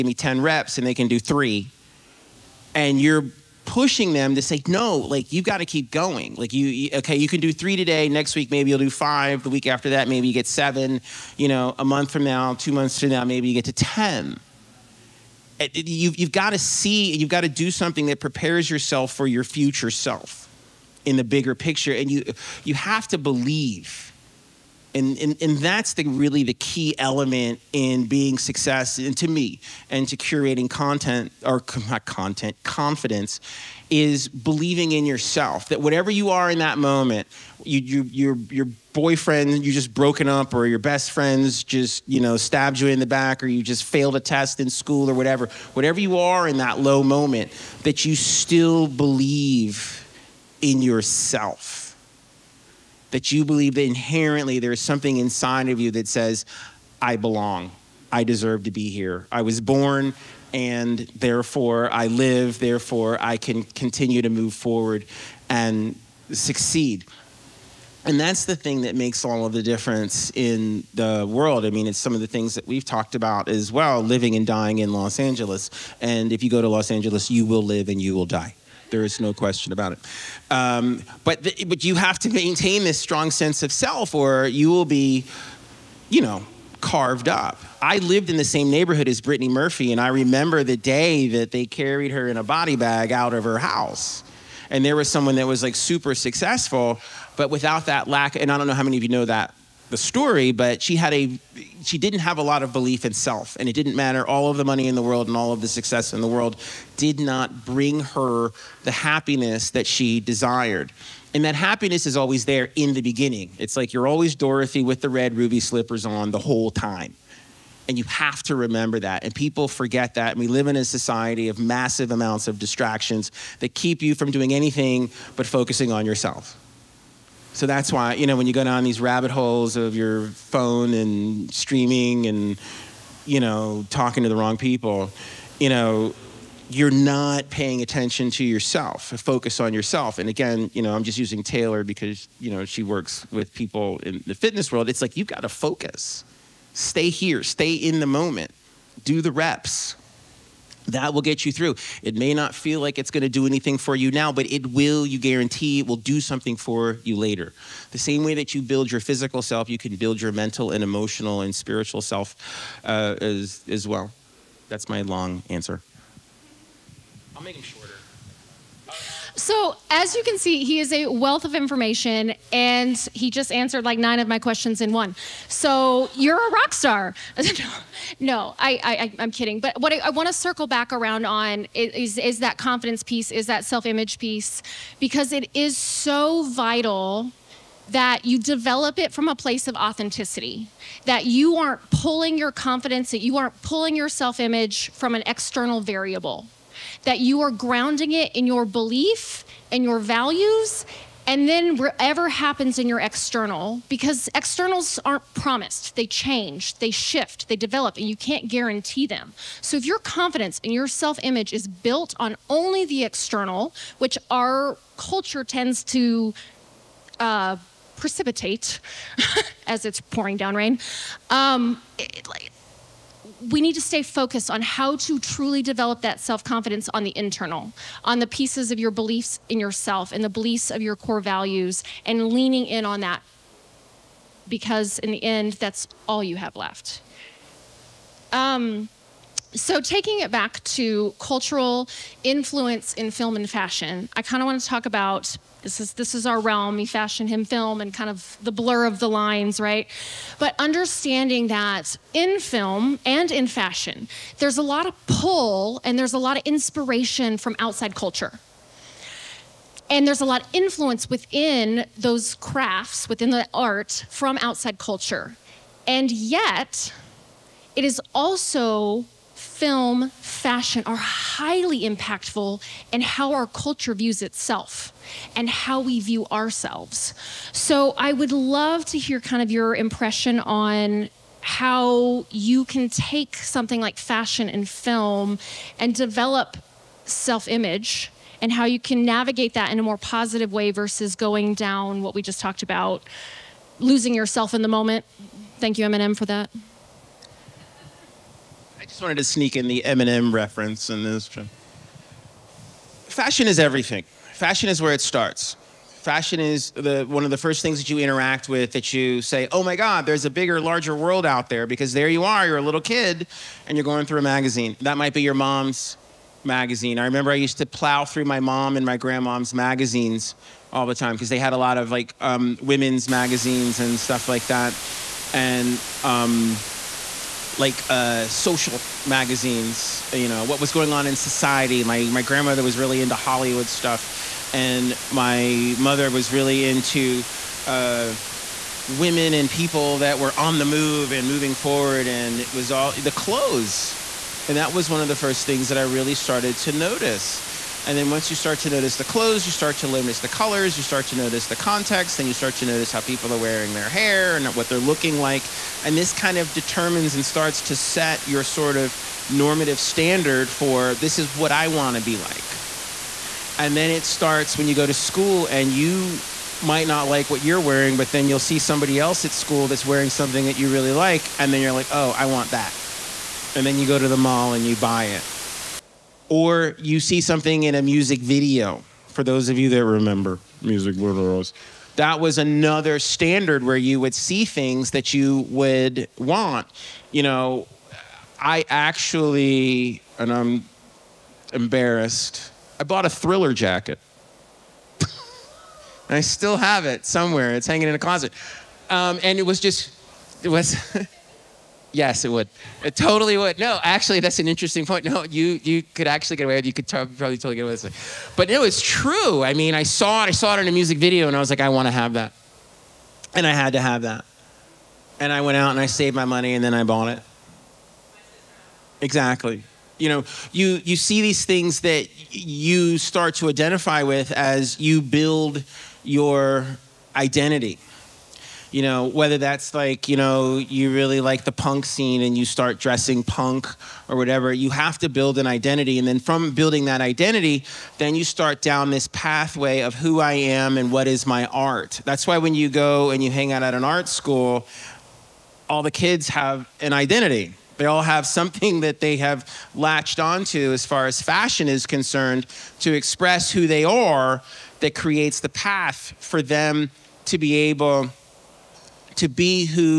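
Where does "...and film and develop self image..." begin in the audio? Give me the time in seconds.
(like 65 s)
284 s.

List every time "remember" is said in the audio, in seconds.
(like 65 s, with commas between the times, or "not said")
90 s, 118 s, 317 s, 379 s.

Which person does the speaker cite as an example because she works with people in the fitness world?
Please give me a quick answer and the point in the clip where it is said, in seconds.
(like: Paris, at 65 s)
Taylor, at 141 s.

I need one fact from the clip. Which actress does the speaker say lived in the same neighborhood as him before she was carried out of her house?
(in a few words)
Brittany Murphy.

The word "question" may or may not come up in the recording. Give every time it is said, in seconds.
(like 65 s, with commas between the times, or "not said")
79 s, 174 s.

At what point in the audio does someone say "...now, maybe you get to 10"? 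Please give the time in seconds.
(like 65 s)
13 s.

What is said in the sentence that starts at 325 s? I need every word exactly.
And um, like uh, social magazines, you know, what was going on in society.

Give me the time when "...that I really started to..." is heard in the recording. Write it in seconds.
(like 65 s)
345 s.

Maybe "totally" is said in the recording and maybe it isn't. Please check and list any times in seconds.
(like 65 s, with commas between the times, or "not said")
402 s, 407 s.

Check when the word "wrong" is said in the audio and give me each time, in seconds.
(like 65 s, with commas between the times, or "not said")
134 s.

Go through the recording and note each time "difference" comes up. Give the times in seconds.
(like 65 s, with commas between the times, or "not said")
69 s.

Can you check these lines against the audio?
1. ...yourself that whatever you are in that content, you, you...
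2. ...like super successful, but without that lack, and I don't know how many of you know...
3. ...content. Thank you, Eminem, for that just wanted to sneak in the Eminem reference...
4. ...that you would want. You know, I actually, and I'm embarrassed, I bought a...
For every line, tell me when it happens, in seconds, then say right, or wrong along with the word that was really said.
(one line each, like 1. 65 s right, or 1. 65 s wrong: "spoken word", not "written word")
1. 35 s wrong: "moment", not "content"
2. 95 s right
3. 294 s wrong: "moment", not "content"
4. 384 s right.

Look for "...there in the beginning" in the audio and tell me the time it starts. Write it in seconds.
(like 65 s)
112 s.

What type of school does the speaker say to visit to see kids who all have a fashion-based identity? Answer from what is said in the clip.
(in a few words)
art school.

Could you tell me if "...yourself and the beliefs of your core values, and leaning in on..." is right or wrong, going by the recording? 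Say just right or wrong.
right.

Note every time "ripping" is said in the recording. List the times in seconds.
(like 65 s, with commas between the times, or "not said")
not said.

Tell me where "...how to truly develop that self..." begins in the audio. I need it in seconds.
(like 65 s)
224 s.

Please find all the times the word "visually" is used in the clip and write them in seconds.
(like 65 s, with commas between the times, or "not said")
not said.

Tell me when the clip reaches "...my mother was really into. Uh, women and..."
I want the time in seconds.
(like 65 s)
335 s.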